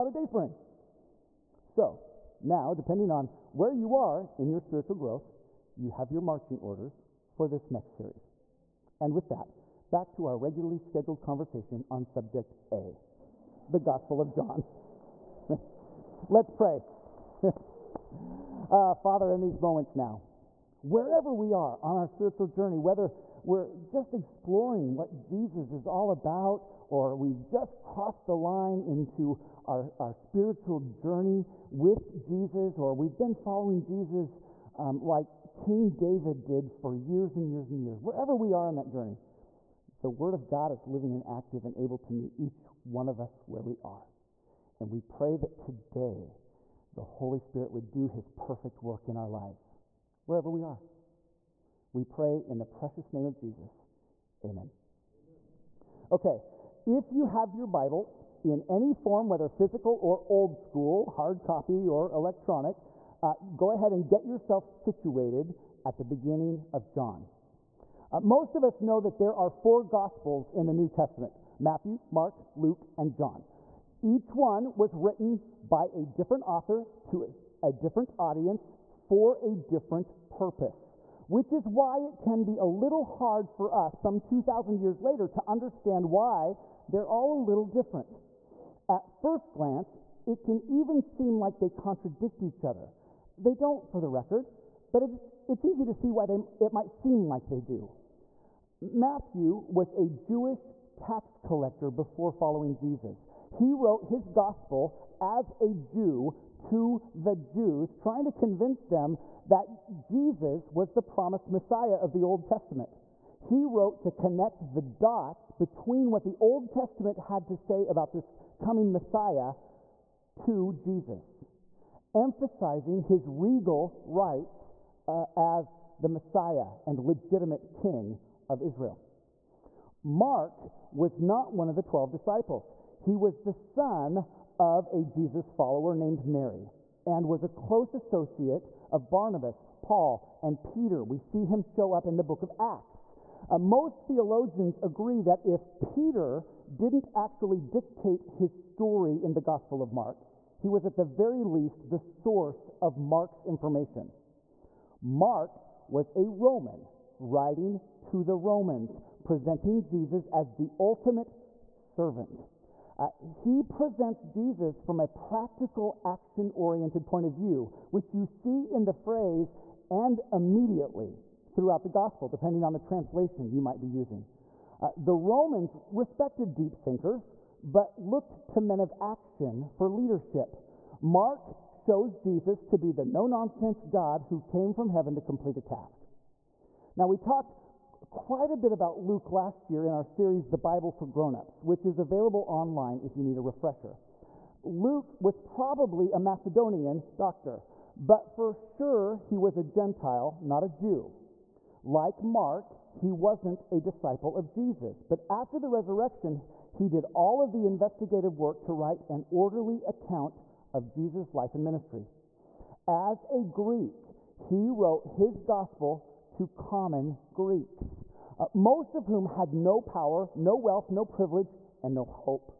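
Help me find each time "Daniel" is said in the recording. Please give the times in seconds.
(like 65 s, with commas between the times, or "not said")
not said.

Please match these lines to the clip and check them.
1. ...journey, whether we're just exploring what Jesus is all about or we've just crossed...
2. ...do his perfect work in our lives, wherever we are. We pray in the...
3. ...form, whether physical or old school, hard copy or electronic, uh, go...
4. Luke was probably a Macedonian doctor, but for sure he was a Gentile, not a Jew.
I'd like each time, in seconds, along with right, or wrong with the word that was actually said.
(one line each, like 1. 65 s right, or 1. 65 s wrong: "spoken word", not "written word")
1. 22 s right
2. 47 s right
3. 58 s right
4. 194 s right.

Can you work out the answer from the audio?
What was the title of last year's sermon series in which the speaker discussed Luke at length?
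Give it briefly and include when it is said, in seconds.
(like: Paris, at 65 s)
The Bible for Grown-Ups, at 190 s.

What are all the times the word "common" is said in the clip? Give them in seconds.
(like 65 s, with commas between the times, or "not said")
216 s.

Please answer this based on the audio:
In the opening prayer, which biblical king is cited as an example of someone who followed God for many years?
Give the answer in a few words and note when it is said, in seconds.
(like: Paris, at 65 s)
King David, at 35 s.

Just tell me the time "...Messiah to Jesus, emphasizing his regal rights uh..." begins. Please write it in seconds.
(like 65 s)
118 s.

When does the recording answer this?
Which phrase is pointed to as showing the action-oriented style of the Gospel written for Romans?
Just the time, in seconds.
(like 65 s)
169 s.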